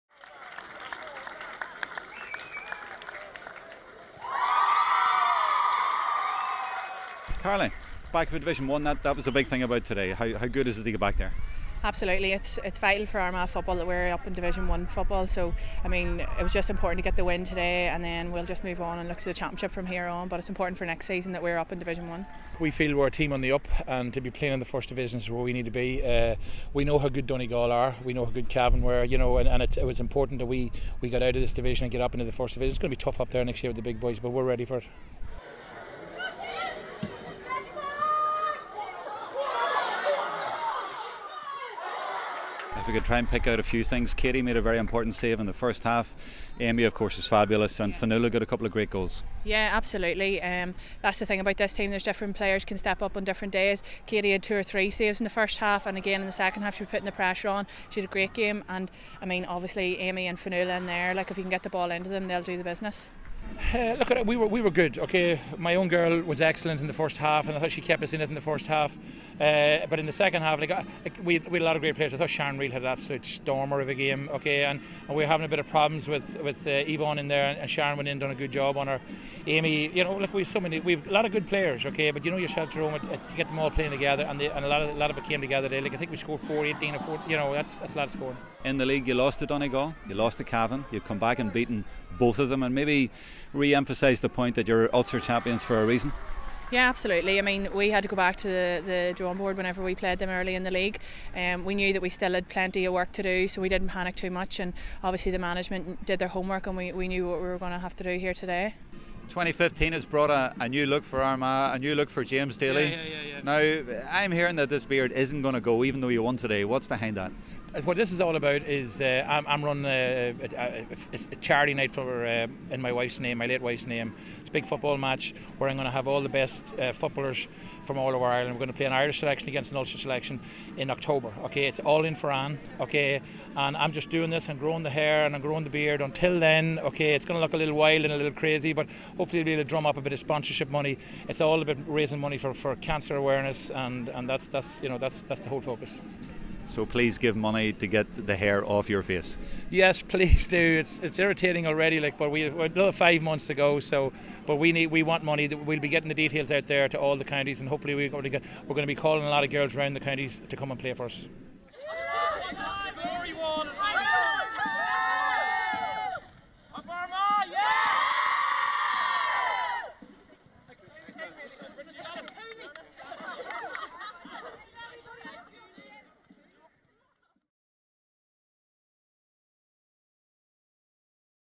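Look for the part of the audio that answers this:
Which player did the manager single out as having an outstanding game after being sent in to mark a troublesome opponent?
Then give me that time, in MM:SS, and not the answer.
01:12.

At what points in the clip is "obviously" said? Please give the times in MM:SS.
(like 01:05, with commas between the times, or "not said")
00:59, 01:45.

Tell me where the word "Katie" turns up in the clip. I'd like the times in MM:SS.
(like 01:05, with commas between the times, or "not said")
00:44, 00:54.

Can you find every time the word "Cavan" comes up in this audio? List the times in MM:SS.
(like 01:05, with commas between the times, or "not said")
00:28, 01:30.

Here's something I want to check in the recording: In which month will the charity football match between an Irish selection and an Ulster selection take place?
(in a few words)
October.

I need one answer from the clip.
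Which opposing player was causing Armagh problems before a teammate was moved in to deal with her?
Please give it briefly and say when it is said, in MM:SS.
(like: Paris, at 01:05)
Yvonne, at 01:16.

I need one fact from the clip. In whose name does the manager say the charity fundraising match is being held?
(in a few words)
Anne.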